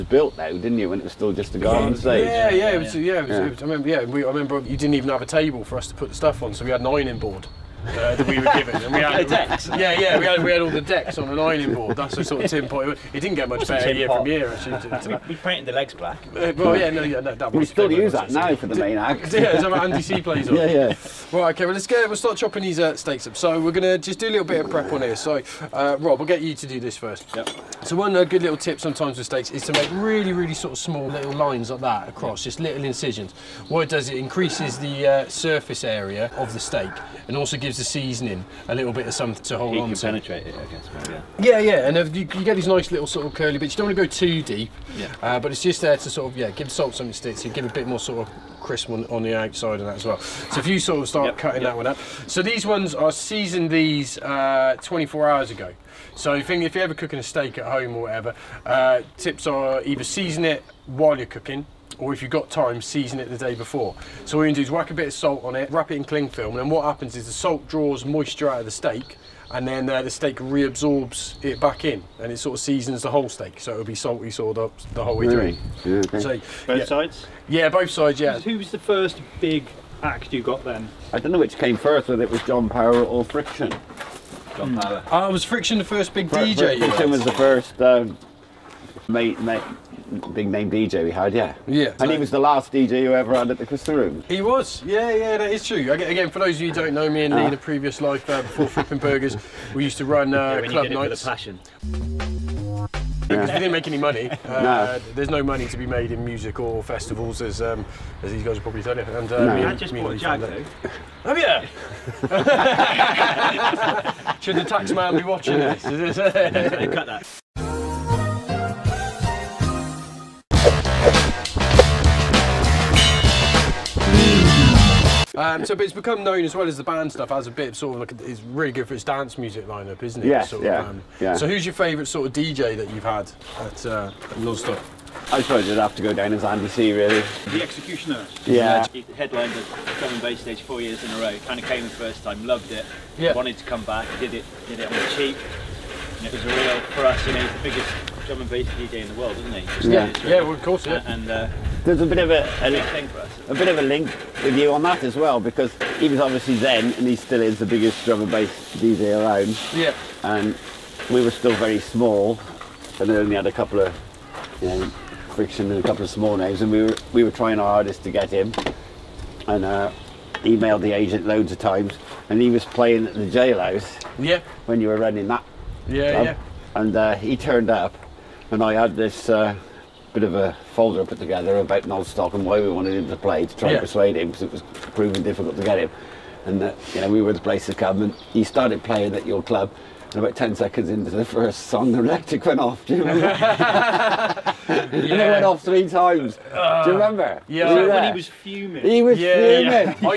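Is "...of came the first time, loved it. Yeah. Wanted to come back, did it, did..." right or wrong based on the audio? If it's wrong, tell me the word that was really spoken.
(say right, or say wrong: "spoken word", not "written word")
right.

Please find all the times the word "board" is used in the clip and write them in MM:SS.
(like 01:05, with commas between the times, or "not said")
00:07, 00:11.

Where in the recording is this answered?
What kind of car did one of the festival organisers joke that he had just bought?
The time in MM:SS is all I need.
01:50.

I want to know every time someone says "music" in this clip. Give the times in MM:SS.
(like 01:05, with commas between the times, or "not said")
01:46, 02:09.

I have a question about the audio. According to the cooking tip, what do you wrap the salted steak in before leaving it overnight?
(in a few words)
Cling film.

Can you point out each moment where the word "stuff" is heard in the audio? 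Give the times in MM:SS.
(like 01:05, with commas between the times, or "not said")
00:06, 02:07, 02:14.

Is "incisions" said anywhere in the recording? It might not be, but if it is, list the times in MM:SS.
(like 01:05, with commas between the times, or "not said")
00:32.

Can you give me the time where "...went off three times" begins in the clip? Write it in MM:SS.
03:15.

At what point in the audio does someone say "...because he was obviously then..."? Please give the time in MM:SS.
02:35.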